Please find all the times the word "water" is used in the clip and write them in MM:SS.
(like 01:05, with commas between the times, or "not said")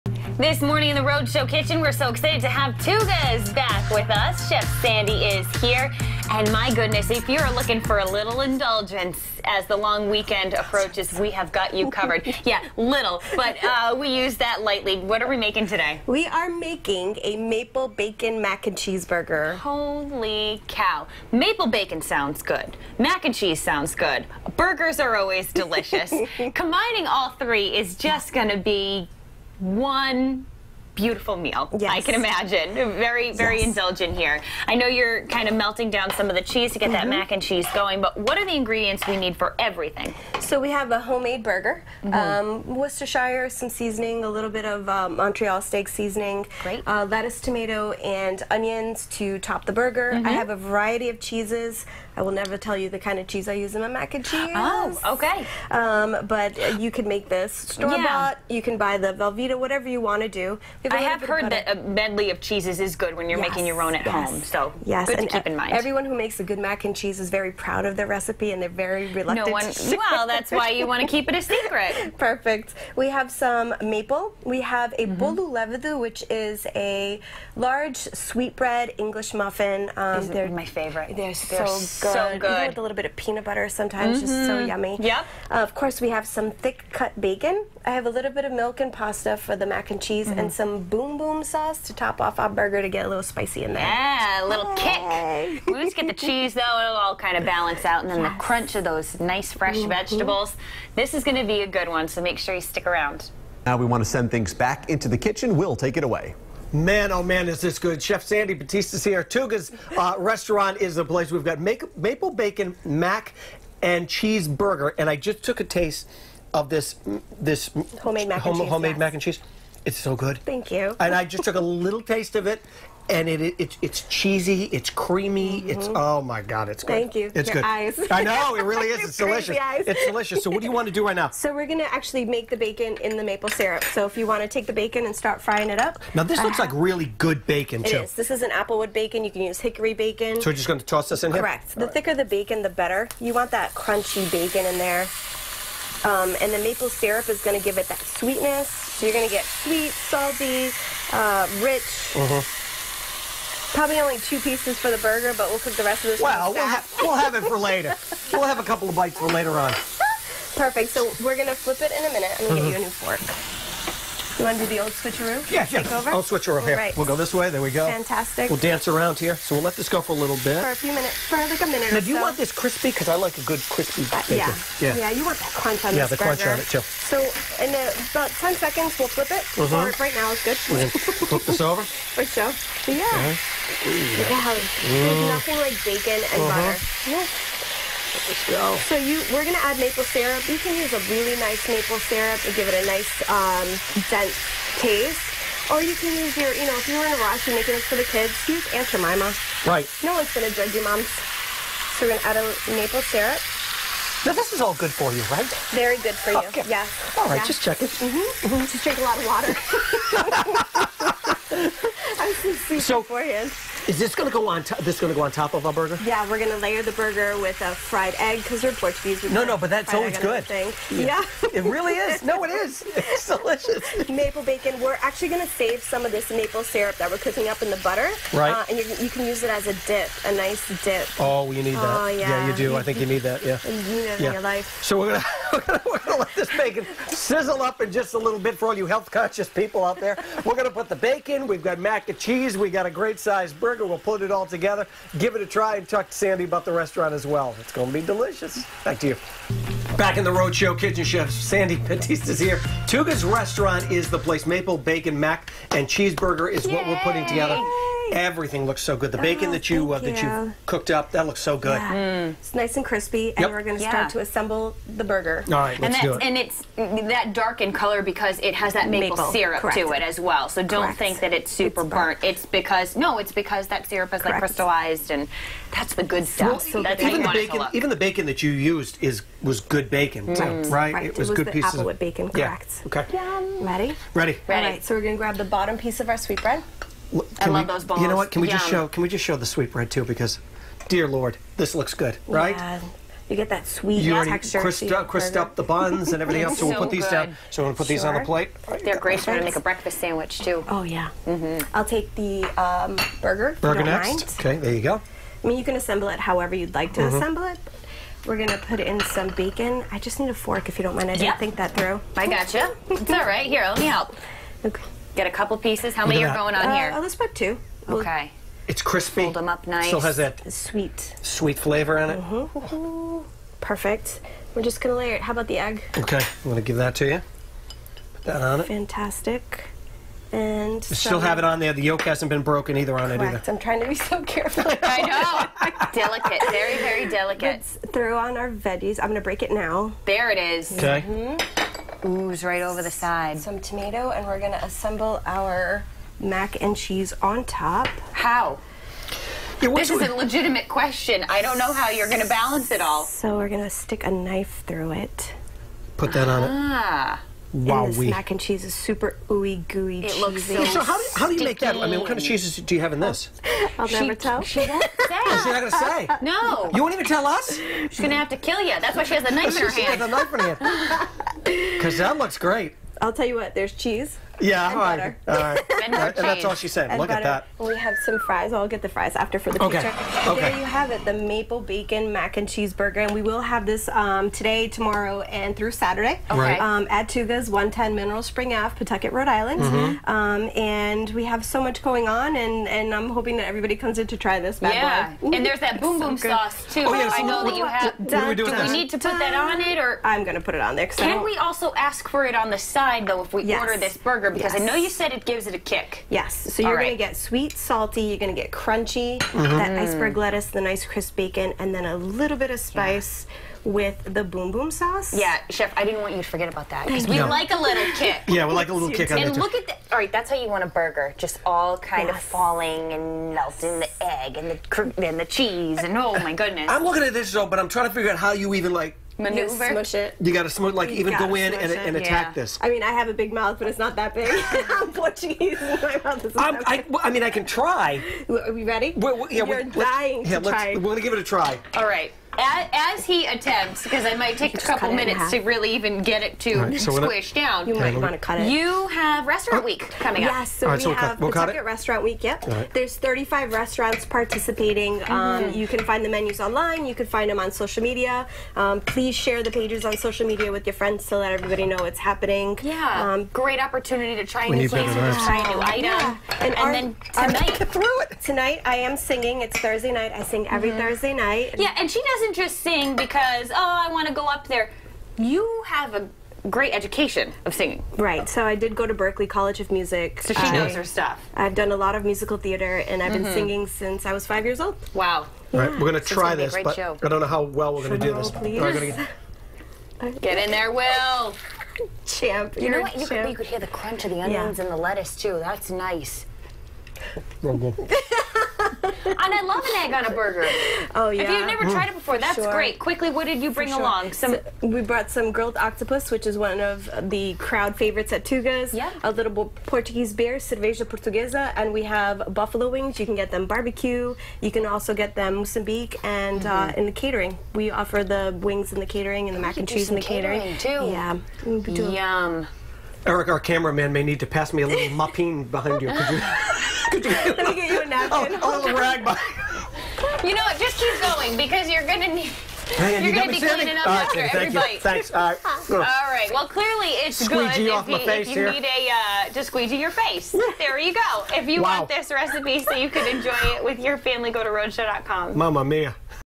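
03:29.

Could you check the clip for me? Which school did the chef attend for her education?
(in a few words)
Berklee College of Music.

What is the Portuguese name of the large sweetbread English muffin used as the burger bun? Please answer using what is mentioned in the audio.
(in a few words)
bolo levedo.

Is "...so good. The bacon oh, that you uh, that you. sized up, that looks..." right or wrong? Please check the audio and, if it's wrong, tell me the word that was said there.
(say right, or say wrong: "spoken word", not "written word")
wrong: "cooked", not "sized".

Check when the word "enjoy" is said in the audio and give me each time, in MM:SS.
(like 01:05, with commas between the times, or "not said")
09:03.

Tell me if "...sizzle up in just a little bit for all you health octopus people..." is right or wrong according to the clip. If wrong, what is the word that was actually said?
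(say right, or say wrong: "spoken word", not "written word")
wrong: "conscious", not "octopus".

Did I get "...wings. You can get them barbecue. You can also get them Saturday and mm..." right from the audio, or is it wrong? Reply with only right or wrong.
wrong.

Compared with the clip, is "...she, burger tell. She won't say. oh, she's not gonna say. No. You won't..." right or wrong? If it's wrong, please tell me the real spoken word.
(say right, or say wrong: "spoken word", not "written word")
wrong: "never", not "burger".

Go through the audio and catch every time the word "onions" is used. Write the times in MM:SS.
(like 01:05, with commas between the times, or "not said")
00:48, 08:14.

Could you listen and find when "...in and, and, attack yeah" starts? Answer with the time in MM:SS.
07:11.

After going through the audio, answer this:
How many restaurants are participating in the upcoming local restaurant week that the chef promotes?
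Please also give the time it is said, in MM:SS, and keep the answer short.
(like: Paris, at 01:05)
35, at 07:32.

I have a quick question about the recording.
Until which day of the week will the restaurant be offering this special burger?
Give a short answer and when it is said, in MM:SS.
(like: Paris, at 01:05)
Saturday, at 06:25.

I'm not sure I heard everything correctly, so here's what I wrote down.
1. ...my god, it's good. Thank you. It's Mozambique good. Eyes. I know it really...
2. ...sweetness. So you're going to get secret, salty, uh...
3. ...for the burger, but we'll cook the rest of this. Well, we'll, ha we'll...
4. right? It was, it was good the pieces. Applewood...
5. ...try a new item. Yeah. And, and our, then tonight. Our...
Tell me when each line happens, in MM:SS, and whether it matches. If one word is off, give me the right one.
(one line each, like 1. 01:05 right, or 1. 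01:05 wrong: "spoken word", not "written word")
1. 02:06 wrong: "Your", not "Mozambique"
2. 02:27 wrong: "sweet", not "secret"
3. 02:34 right
4. 04:40 right
5. 07:45 right.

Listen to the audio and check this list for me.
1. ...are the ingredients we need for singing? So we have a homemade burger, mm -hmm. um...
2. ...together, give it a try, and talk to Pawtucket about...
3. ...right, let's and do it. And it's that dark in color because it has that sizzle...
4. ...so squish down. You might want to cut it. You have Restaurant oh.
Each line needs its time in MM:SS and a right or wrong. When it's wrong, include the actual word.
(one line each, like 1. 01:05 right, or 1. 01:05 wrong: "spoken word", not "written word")
1. 00:38 wrong: "everything", not "singing"
2. 04:04 wrong: "Sandy", not "Pawtucket"
3. 04:25 wrong: "maple", not "sizzle"
4. 07:26 right.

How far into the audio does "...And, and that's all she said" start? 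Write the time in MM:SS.
06:15.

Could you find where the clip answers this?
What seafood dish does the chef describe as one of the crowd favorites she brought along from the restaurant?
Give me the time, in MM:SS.
08:25.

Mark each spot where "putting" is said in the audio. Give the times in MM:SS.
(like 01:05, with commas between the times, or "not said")
04:16.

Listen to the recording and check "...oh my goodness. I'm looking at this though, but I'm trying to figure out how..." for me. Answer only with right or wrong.
right.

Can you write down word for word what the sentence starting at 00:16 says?
We are making a maple bacon mac and cheeseburger.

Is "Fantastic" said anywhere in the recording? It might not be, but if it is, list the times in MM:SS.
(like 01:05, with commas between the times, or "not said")
02:47, 05:28.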